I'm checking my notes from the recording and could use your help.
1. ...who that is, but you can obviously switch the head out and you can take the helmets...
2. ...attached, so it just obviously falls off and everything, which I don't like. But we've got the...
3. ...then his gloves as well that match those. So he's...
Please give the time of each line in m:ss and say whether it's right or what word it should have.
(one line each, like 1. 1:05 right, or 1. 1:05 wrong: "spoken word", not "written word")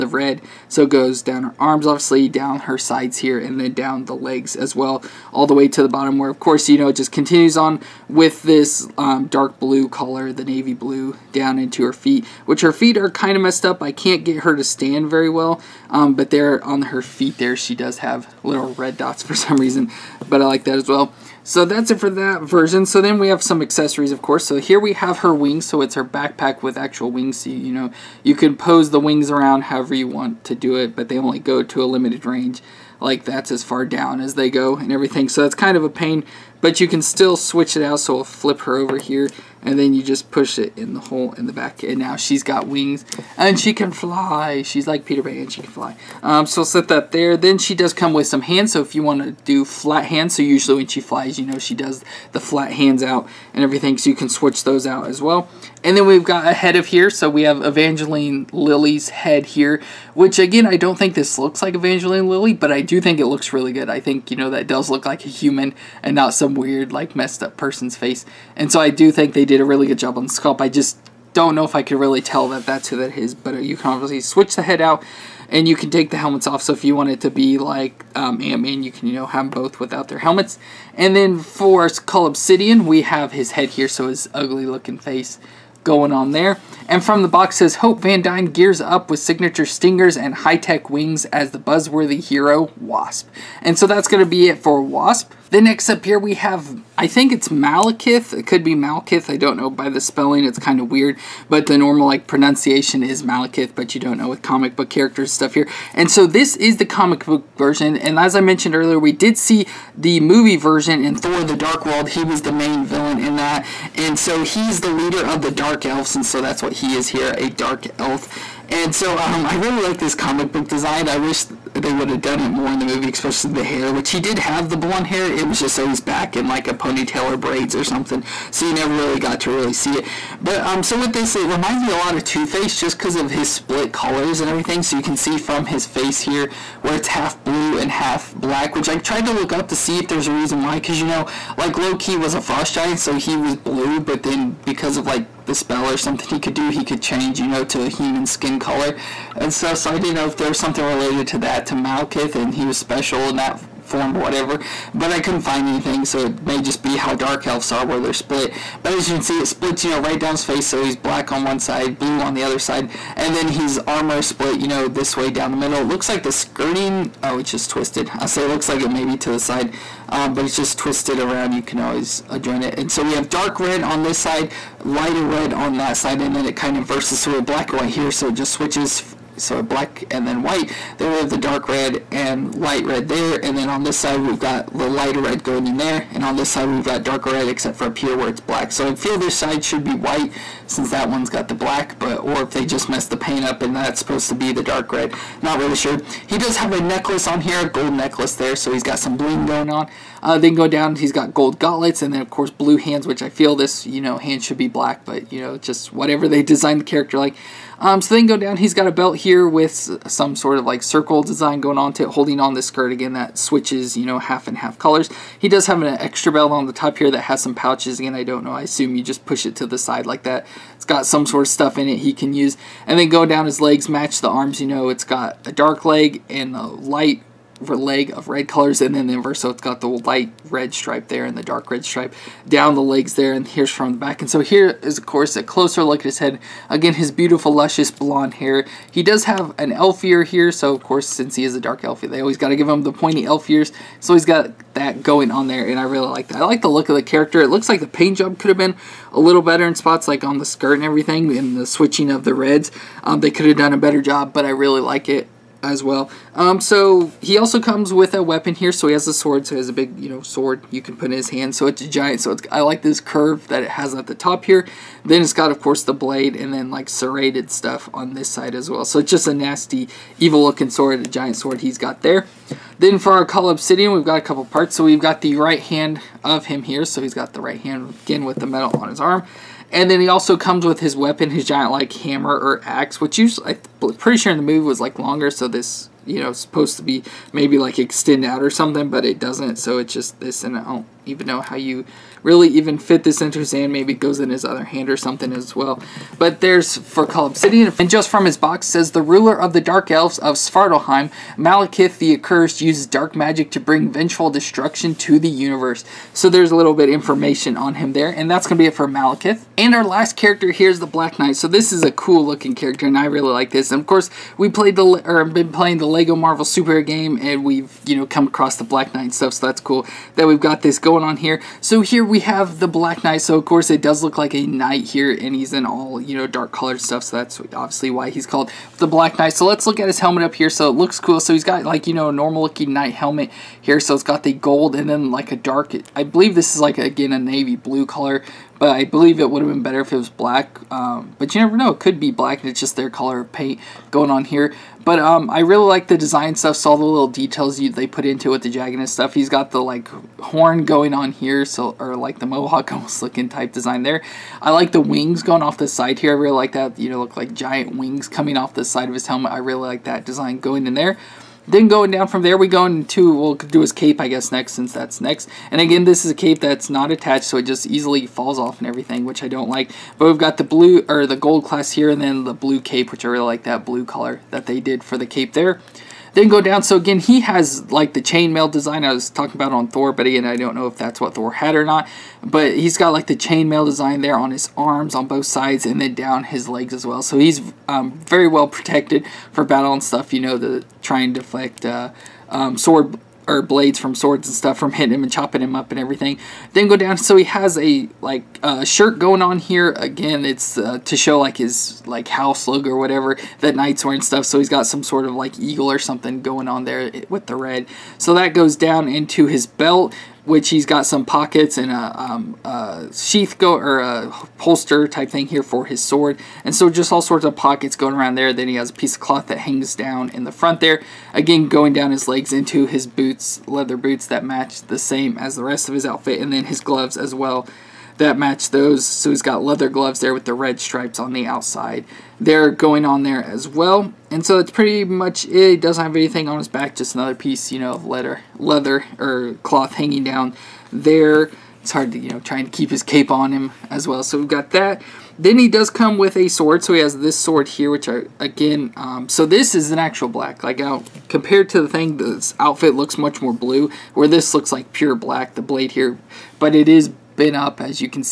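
1. 1:12 right
2. 6:06 wrong: "easily", not "obviously"
3. 7:06 right.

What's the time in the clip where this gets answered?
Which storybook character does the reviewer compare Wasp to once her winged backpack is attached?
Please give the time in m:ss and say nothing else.
0:45.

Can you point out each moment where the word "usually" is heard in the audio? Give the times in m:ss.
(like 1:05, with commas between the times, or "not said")
0:50, 4:43.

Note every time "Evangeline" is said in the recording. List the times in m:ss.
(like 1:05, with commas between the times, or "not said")
0:57, 1:01.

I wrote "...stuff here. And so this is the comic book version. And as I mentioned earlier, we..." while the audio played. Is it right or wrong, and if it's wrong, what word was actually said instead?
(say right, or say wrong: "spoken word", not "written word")
right.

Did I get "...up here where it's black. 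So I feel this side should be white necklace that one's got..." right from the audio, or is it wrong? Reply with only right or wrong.
wrong.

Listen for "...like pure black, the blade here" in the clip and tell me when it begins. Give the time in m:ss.
7:34.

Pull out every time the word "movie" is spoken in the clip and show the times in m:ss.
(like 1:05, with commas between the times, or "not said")
1:50, 2:02, 4:44.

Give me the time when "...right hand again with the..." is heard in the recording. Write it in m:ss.
4:37.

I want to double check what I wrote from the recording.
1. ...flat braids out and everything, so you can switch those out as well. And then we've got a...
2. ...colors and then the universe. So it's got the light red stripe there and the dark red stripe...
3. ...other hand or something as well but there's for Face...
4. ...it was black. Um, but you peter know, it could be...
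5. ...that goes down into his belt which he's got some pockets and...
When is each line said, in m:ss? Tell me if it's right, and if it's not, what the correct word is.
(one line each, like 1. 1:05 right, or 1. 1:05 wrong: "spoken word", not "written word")
1. 0:52 wrong: "hands", not "braids"
2. 3:48 wrong: "inverse", not "universe"
3. 4:54 wrong: "Cull", not "Face"
4. 5:39 wrong: "never", not "peter"
5. 6:48 right.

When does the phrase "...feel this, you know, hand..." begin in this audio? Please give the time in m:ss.
3:23.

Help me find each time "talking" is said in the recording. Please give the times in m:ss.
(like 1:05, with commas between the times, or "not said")
6:19.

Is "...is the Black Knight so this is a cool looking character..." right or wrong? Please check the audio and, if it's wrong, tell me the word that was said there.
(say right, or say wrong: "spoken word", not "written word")
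right.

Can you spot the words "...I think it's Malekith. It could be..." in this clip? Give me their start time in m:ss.
1:36.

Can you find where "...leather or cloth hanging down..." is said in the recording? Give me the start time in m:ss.
7:18.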